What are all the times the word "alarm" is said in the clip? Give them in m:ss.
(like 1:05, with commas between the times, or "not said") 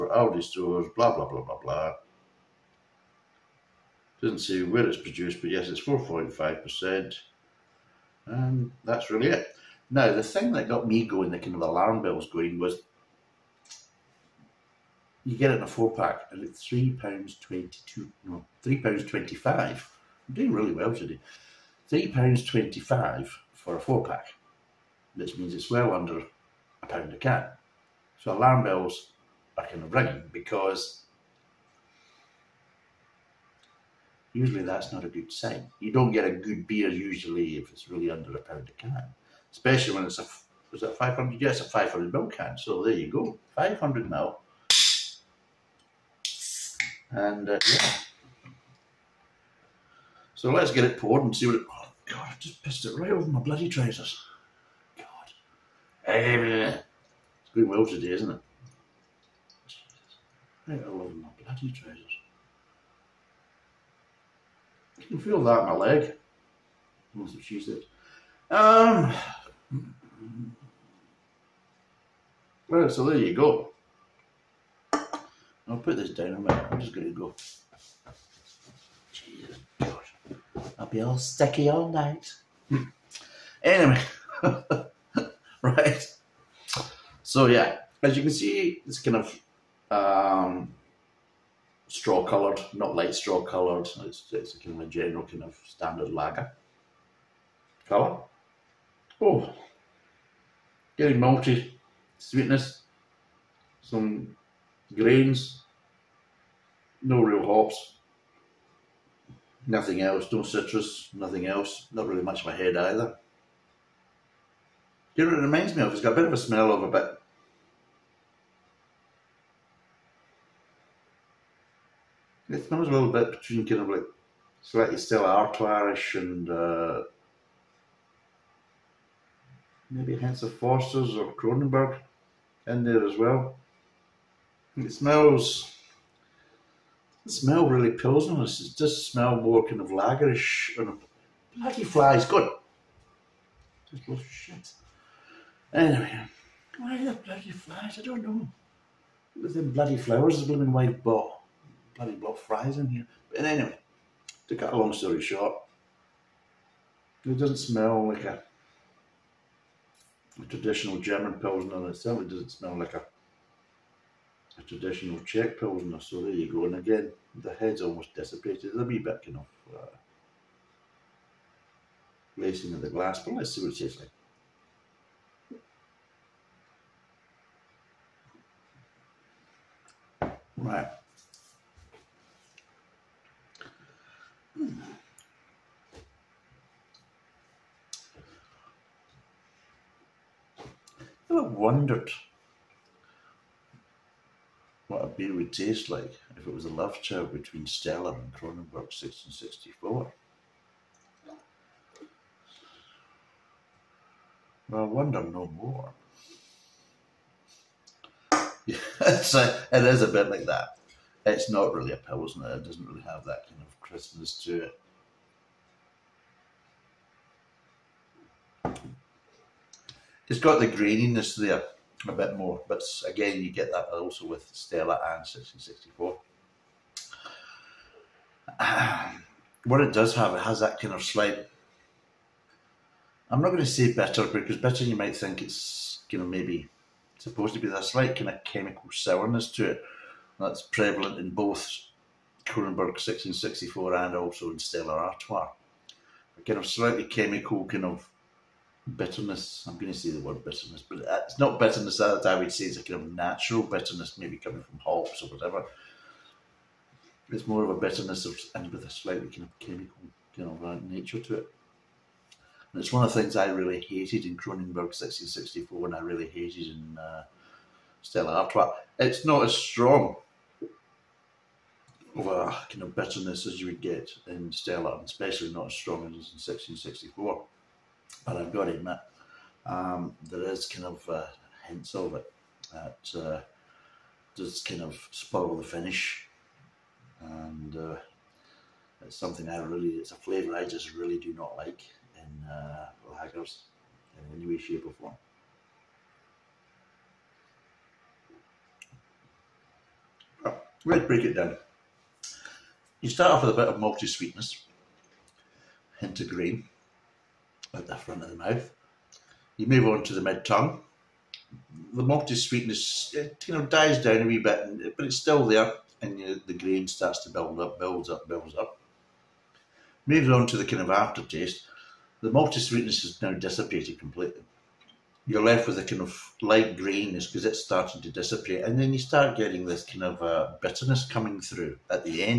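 0:11, 0:28.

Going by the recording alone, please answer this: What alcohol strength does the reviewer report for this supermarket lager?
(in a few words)
4.5%.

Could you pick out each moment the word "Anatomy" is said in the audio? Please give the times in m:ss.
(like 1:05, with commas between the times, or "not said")
not said.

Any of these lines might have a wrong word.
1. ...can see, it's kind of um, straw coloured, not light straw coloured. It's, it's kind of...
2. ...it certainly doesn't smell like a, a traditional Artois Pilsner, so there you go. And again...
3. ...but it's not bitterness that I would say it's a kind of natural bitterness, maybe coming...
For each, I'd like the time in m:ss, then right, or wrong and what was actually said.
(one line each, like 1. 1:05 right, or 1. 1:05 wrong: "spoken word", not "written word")
1. 1:28 right
2. 2:41 wrong: "Czech", not "Artois"
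3. 4:10 right.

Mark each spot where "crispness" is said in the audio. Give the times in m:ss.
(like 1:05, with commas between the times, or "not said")
3:33.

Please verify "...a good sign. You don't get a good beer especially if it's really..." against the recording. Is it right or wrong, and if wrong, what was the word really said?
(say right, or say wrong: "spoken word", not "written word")
wrong: "usually", not "especially".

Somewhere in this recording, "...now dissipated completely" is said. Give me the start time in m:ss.
5:23.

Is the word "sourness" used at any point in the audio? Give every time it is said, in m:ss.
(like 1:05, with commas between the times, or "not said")
3:58.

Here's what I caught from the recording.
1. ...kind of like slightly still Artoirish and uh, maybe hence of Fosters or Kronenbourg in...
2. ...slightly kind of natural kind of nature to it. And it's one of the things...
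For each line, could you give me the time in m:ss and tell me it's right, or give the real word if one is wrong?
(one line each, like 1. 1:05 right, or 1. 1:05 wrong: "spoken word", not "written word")
1. 2:03 right
2. 4:18 wrong: "chemical", not "natural".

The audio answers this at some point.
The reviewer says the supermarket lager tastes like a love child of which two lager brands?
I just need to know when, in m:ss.
3:17.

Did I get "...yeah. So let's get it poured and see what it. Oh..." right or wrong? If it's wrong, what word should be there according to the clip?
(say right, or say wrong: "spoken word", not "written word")
right.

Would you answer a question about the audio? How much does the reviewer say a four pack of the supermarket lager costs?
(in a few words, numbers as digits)
£3.25.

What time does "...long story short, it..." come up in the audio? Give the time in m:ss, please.
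2:34.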